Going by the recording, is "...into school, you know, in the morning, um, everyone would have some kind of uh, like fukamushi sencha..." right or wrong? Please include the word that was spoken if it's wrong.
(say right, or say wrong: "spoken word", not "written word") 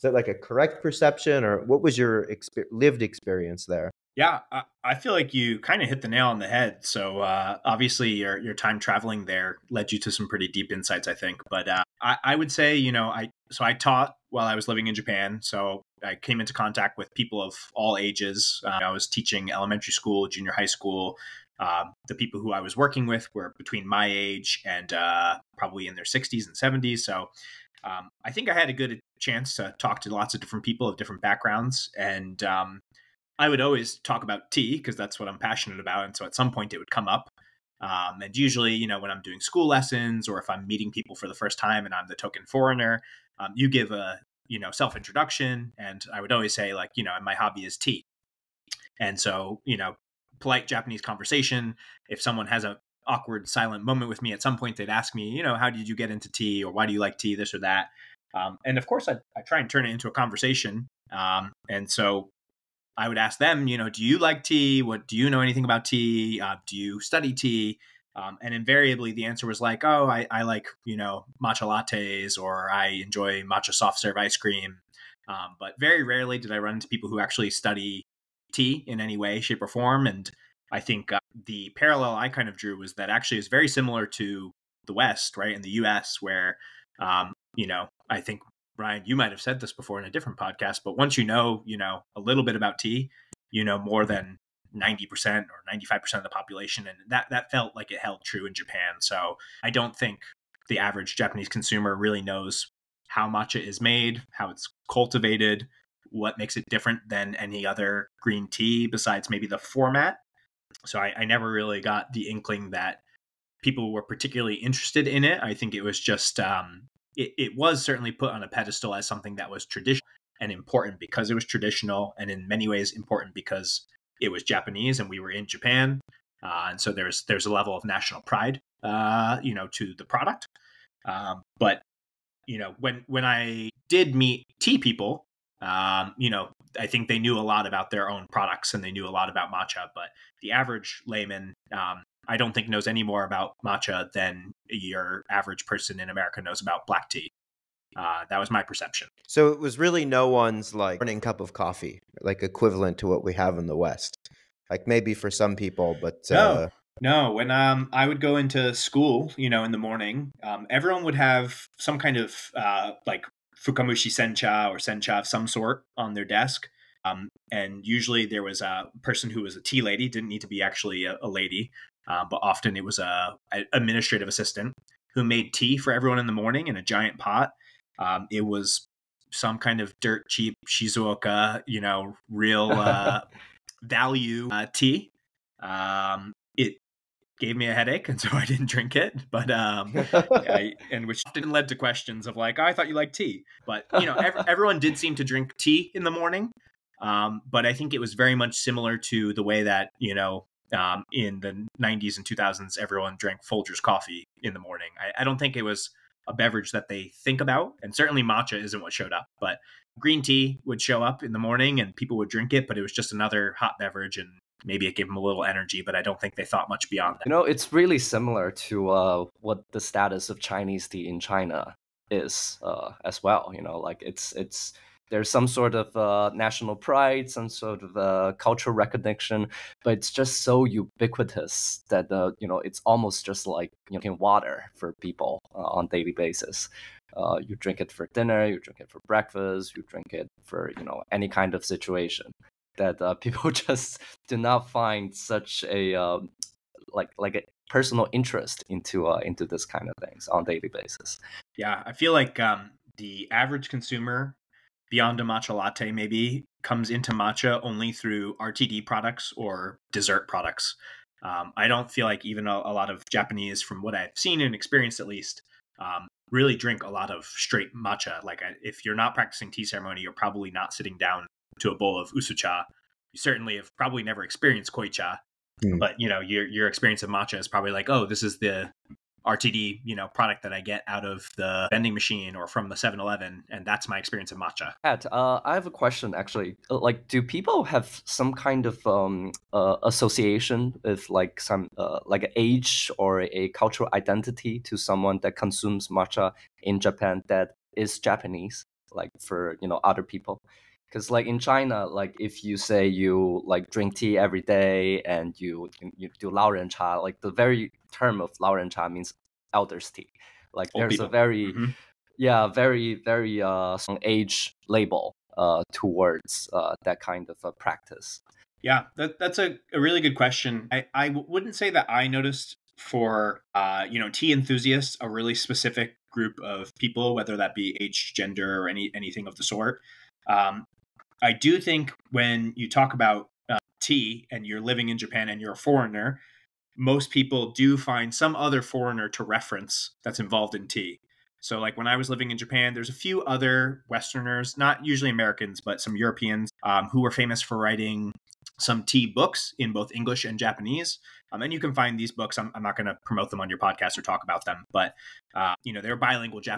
right.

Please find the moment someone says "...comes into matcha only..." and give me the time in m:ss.
4:16.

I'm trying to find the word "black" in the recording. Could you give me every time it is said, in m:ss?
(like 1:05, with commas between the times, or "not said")
2:26.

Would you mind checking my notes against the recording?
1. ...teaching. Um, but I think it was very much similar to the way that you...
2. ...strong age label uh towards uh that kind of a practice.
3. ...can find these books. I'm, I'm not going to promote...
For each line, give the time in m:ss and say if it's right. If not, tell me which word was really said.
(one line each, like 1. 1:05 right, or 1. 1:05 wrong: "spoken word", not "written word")
1. 3:16 wrong: "morning", not "teaching"
2. 5:13 right
3. 5:51 right.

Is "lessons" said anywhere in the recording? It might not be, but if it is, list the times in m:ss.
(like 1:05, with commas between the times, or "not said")
0:39.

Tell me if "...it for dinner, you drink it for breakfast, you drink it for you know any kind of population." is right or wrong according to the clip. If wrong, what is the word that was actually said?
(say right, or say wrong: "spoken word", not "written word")
wrong: "situation", not "population".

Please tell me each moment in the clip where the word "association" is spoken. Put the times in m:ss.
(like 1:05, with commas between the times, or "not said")
4:49.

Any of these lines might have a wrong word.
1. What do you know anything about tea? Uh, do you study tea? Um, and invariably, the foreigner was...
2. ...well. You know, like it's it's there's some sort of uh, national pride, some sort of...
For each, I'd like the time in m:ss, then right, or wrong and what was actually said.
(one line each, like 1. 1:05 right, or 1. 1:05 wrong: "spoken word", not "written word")
1. 1:04 wrong: "answer", not "foreigner"
2. 3:43 right.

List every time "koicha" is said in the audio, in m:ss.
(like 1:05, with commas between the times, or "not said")
4:34.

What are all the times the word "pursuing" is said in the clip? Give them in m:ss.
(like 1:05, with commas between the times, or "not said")
not said.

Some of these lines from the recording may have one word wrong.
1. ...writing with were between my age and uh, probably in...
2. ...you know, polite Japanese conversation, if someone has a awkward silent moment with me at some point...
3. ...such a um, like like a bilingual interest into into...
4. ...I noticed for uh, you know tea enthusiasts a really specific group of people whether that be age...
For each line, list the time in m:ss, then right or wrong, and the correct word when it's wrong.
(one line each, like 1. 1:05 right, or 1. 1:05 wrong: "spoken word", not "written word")
1. 0:22 wrong: "working", not "writing"
2. 0:49 right
3. 4:05 wrong: "personal", not "bilingual"
4. 5:21 right.